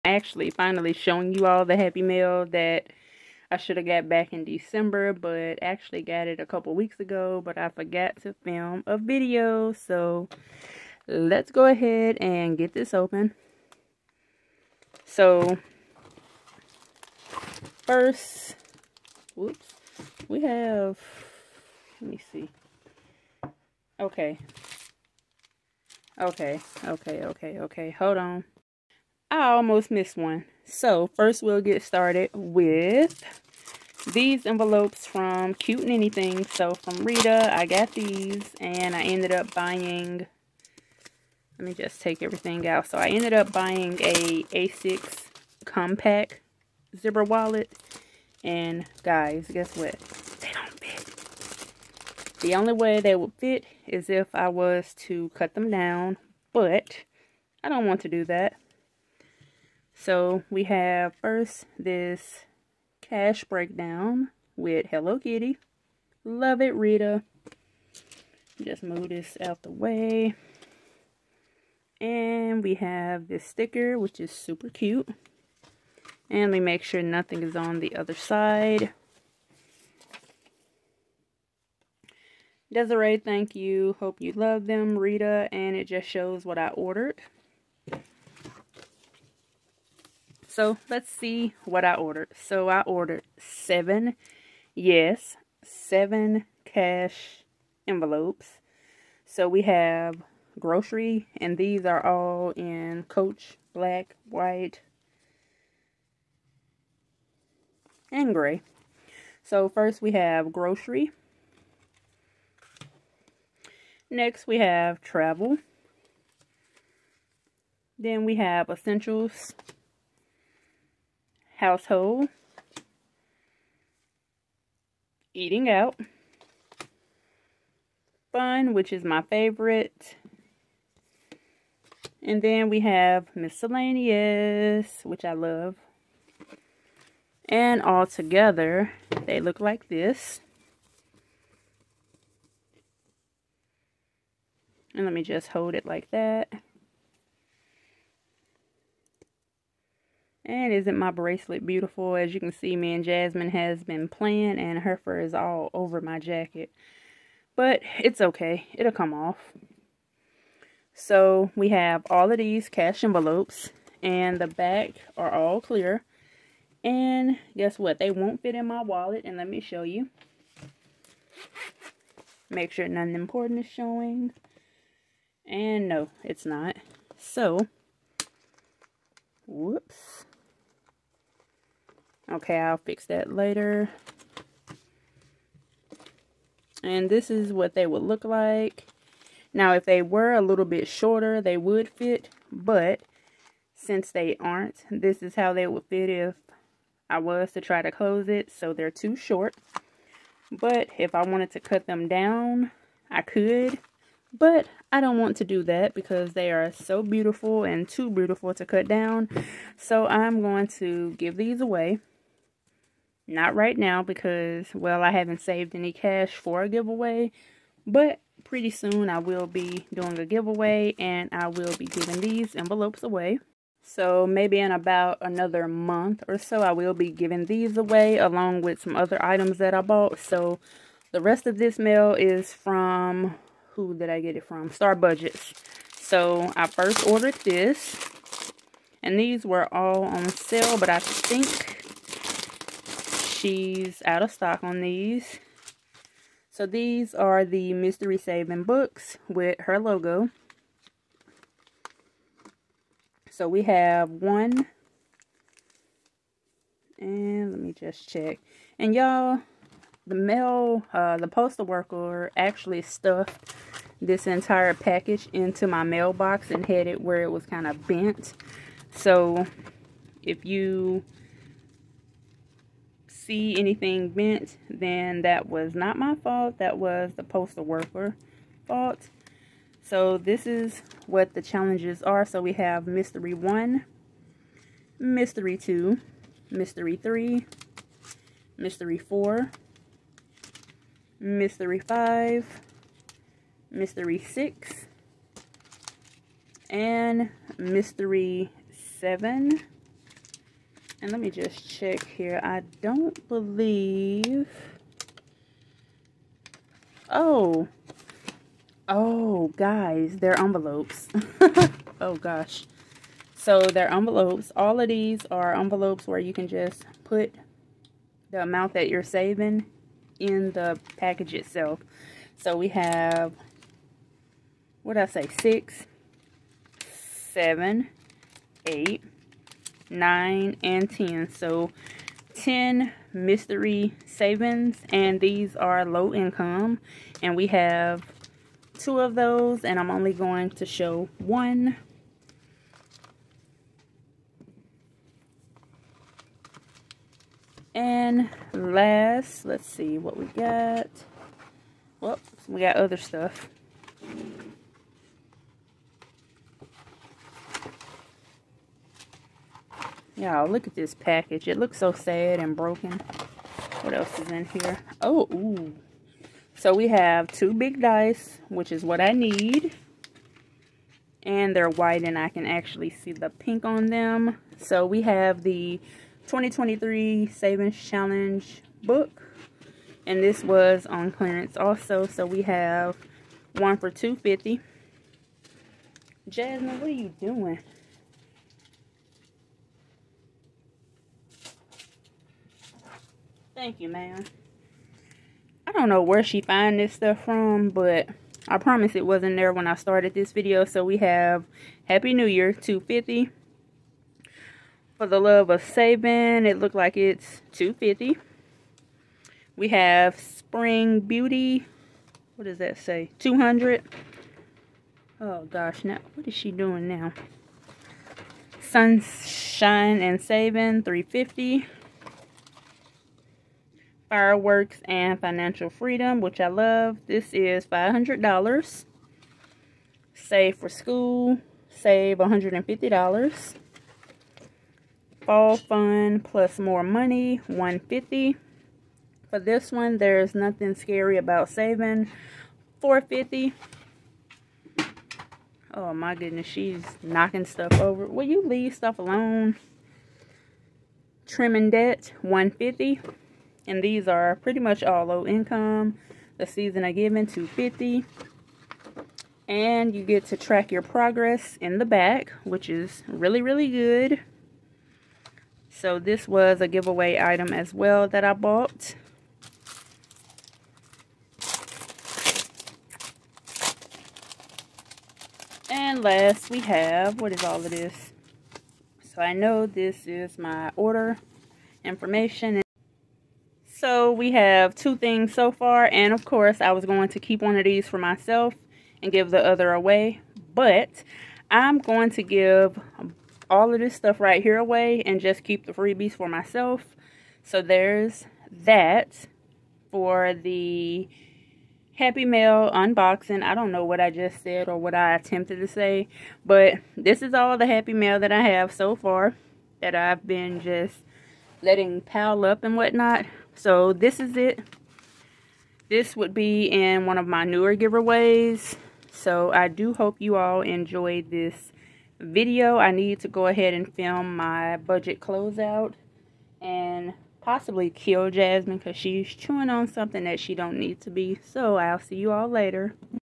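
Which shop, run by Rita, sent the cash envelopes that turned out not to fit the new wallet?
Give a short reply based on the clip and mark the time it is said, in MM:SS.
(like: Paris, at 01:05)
Cute Neni Things, at 00:35.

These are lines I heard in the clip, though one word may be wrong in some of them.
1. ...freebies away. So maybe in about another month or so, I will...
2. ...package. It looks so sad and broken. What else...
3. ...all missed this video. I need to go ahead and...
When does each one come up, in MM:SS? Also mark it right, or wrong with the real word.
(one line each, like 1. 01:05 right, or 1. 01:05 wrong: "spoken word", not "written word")
1. 03:42 wrong: "envelopes", not "freebies"
2. 06:00 right
3. 08:40 wrong: "enjoyed", not "missed".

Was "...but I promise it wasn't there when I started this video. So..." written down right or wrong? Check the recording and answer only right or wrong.
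right.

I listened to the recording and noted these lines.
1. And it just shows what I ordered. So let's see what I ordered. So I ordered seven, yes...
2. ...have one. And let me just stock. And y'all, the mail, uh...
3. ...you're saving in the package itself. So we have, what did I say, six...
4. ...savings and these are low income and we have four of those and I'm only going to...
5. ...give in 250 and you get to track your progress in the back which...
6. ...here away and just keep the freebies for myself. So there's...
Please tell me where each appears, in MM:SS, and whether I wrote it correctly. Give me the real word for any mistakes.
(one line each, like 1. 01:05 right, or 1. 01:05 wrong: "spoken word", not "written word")
1. 01:25 right
2. 04:13 wrong: "check", not "stock"
3. 05:18 right
4. 05:34 wrong: "two", not "four"
5. 07:36 right
6. 08:14 right.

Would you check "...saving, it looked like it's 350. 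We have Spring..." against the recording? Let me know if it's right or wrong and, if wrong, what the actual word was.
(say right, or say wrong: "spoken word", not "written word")
wrong: "250", not "350".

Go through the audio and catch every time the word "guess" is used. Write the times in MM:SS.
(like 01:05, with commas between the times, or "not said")
00:49, 02:47.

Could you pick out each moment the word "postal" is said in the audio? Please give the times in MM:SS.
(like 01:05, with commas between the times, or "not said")
04:21, 04:37.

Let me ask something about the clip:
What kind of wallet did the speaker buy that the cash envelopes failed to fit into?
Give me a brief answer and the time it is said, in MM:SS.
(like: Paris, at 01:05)
A6 compact zipper wallet, at 00:44.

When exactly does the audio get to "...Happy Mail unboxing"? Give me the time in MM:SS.
08:21.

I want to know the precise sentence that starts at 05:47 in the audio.
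And last, let's see what we got.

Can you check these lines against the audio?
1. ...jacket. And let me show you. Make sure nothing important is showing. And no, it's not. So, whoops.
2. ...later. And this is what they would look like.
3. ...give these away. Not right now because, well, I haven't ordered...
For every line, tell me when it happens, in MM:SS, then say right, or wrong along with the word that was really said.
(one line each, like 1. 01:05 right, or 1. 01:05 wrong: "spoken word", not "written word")
1. 02:48 wrong: "wallet", not "jacket"
2. 03:03 right
3. 03:31 wrong: "saved", not "ordered".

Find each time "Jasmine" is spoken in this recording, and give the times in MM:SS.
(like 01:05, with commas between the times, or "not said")
02:33, 06:26, 08:48.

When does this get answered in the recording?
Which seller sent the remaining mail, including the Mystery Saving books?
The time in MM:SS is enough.
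03:54.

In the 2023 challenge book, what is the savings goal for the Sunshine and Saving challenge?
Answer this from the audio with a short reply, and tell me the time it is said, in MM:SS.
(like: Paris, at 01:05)
350, at 07:00.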